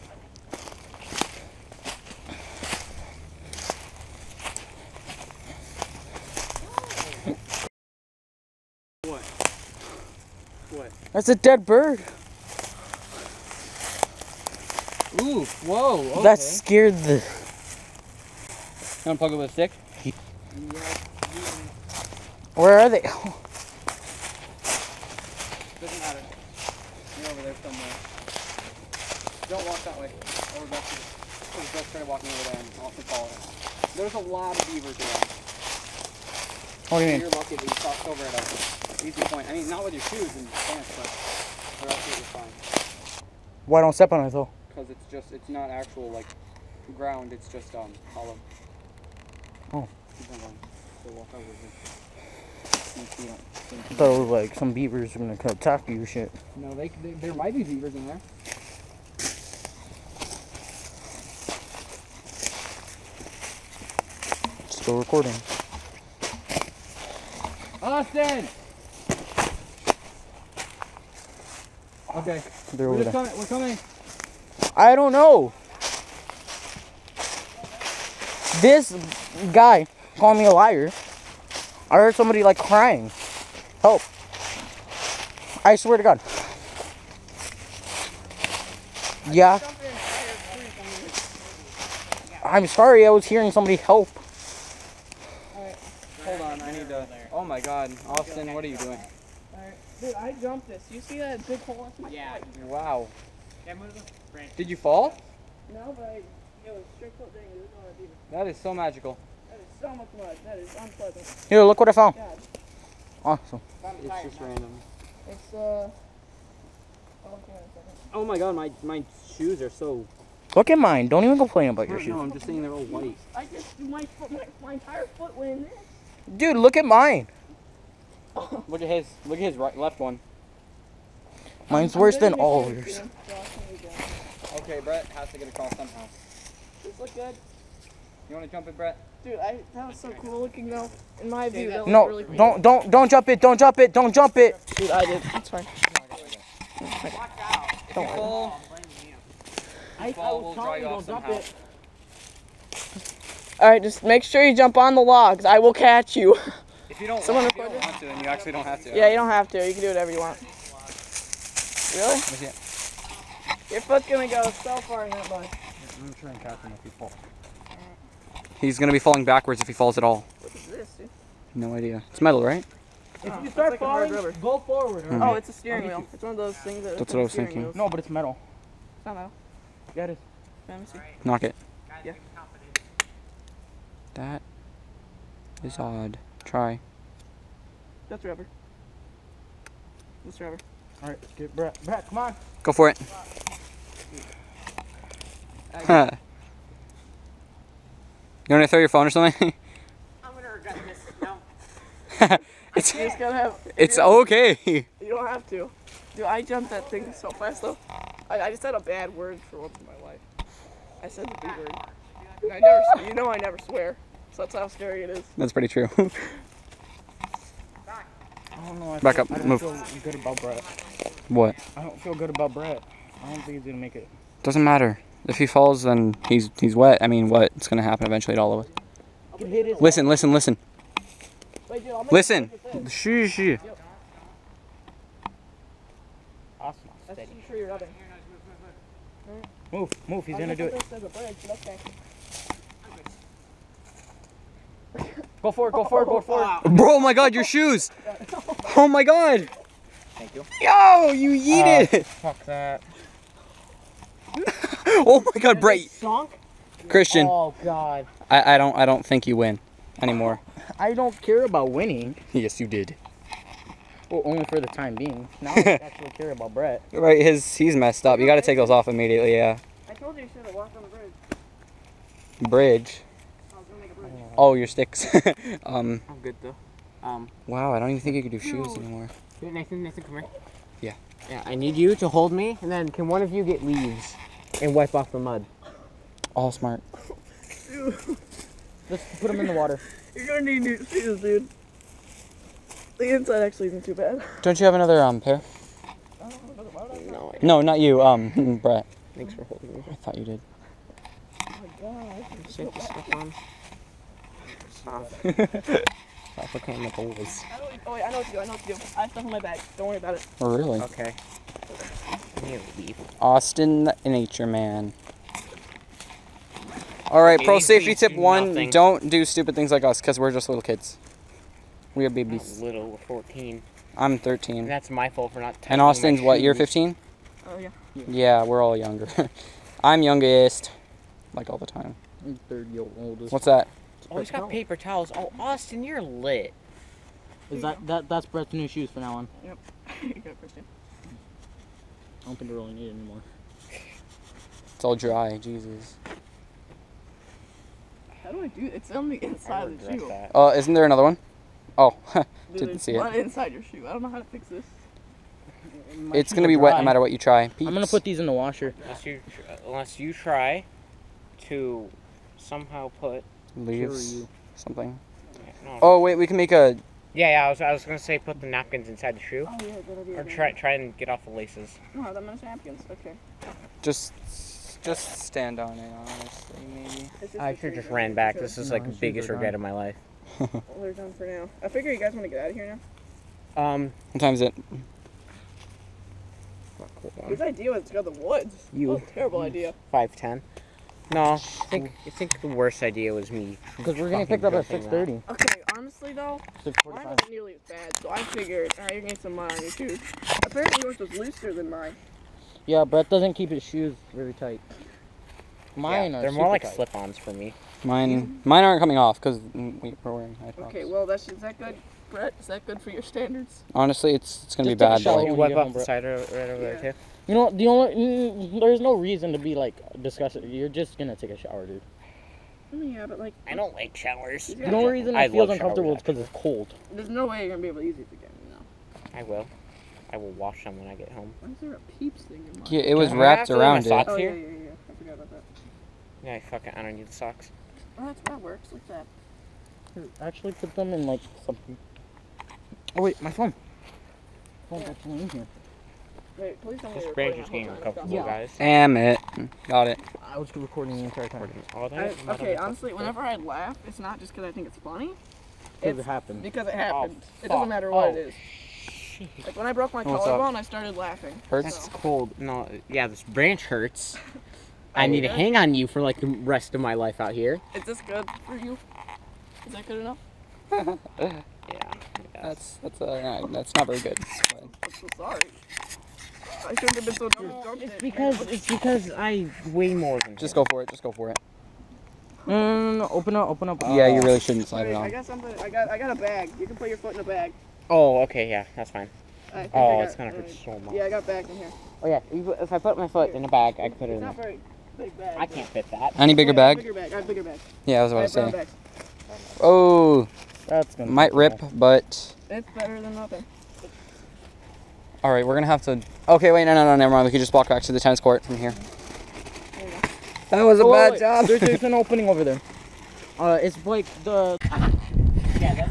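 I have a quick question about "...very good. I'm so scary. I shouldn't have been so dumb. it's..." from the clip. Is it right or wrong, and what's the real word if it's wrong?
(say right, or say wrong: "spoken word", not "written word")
wrong: "sorry", not "scary".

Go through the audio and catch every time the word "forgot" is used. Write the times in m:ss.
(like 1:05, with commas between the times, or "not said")
5:06, 7:14.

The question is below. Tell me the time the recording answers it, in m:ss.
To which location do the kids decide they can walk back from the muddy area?
8:27.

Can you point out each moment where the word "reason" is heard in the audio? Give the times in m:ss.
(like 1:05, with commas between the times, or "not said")
6:58, 7:04.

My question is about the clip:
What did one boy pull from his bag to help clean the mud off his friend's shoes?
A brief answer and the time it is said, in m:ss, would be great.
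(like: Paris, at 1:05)
Paper towels, at 5:34.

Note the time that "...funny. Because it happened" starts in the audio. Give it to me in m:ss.
7:34.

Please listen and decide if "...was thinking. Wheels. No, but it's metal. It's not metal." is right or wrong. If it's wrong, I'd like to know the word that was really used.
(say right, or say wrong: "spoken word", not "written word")
right.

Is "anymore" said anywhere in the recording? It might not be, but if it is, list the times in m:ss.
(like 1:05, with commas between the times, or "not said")
4:20, 4:38, 5:42.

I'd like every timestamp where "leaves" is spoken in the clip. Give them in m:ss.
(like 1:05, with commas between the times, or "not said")
4:43, 6:03.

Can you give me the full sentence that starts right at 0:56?
No, they, they there might be beavers in there.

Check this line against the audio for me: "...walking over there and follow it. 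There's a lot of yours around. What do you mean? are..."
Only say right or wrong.
wrong.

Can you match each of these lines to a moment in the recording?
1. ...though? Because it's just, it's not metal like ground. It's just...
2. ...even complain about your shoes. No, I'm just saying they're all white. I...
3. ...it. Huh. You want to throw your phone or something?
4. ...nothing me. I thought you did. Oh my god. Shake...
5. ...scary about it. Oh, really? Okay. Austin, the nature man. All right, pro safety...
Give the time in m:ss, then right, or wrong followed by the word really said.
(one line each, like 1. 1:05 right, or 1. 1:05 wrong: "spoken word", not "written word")
1. 0:44 wrong: "actual", not "metal"
2. 2:01 right
3. 3:12 right
4. 4:59 wrong: "holding", not "nothing"
5. 5:09 wrong: "worry", not "scary".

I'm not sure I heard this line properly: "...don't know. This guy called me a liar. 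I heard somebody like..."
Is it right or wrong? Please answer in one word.
right.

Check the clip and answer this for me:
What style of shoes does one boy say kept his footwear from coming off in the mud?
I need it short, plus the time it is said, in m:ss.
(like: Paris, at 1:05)
High tops, at 6:50.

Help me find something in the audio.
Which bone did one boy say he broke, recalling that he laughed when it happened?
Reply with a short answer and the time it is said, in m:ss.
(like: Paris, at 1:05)
Collarbone, at 7:40.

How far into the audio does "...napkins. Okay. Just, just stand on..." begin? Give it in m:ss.
6:12.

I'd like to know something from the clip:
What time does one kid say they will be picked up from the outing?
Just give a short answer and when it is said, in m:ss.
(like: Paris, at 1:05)
6:30, at 6:34.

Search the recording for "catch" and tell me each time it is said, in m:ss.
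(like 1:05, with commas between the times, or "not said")
2:35, 2:46.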